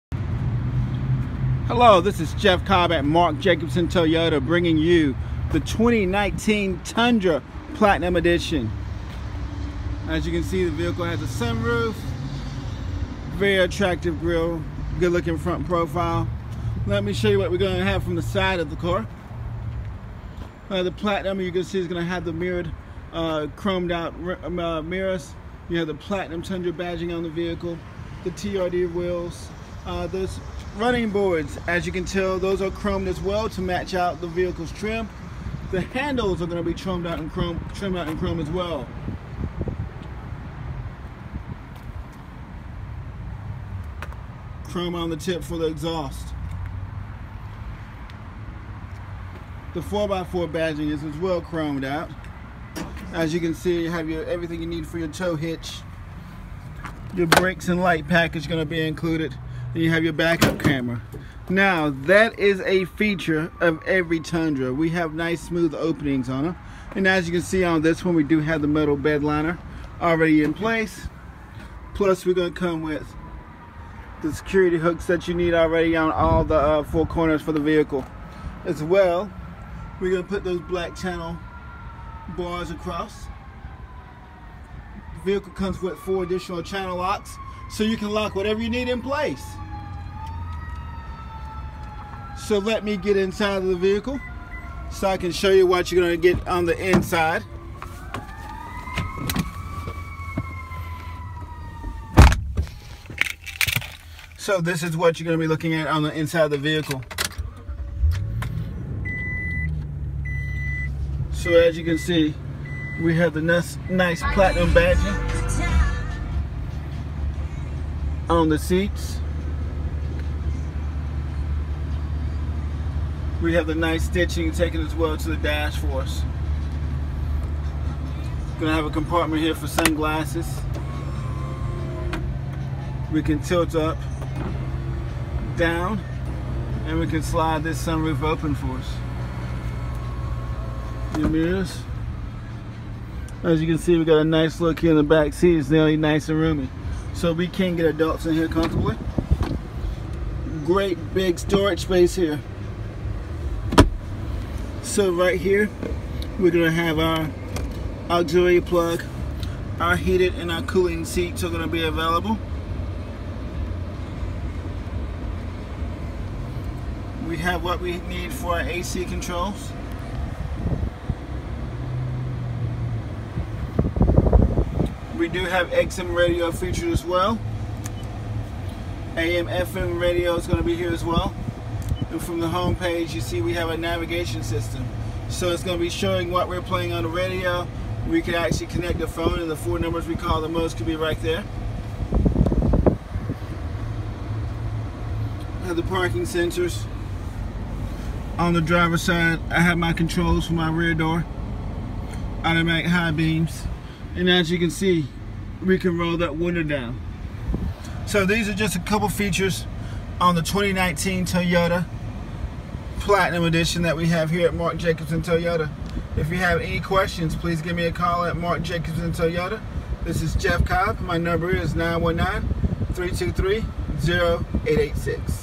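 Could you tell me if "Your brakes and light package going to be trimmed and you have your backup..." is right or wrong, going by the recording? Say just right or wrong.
wrong.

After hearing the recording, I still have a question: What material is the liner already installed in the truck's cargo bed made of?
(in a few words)
metal.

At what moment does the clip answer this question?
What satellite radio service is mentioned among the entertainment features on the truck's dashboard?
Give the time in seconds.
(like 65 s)
175 s.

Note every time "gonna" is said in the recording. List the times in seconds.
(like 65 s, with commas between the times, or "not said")
72 s, 80 s, 128 s, 156 s, 161 s.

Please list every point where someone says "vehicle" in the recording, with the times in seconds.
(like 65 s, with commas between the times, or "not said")
10 s, 27 s, 34 s, 77 s, 85 s, 93 s, 106 s.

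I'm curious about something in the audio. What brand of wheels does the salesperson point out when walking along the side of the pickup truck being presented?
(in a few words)
TRD.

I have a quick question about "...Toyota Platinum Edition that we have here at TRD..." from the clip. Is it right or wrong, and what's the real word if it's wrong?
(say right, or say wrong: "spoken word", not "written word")
wrong: "Mark", not "TRD".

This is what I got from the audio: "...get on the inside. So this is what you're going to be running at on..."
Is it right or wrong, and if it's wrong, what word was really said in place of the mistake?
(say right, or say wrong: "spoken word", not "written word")
wrong: "looking", not "running".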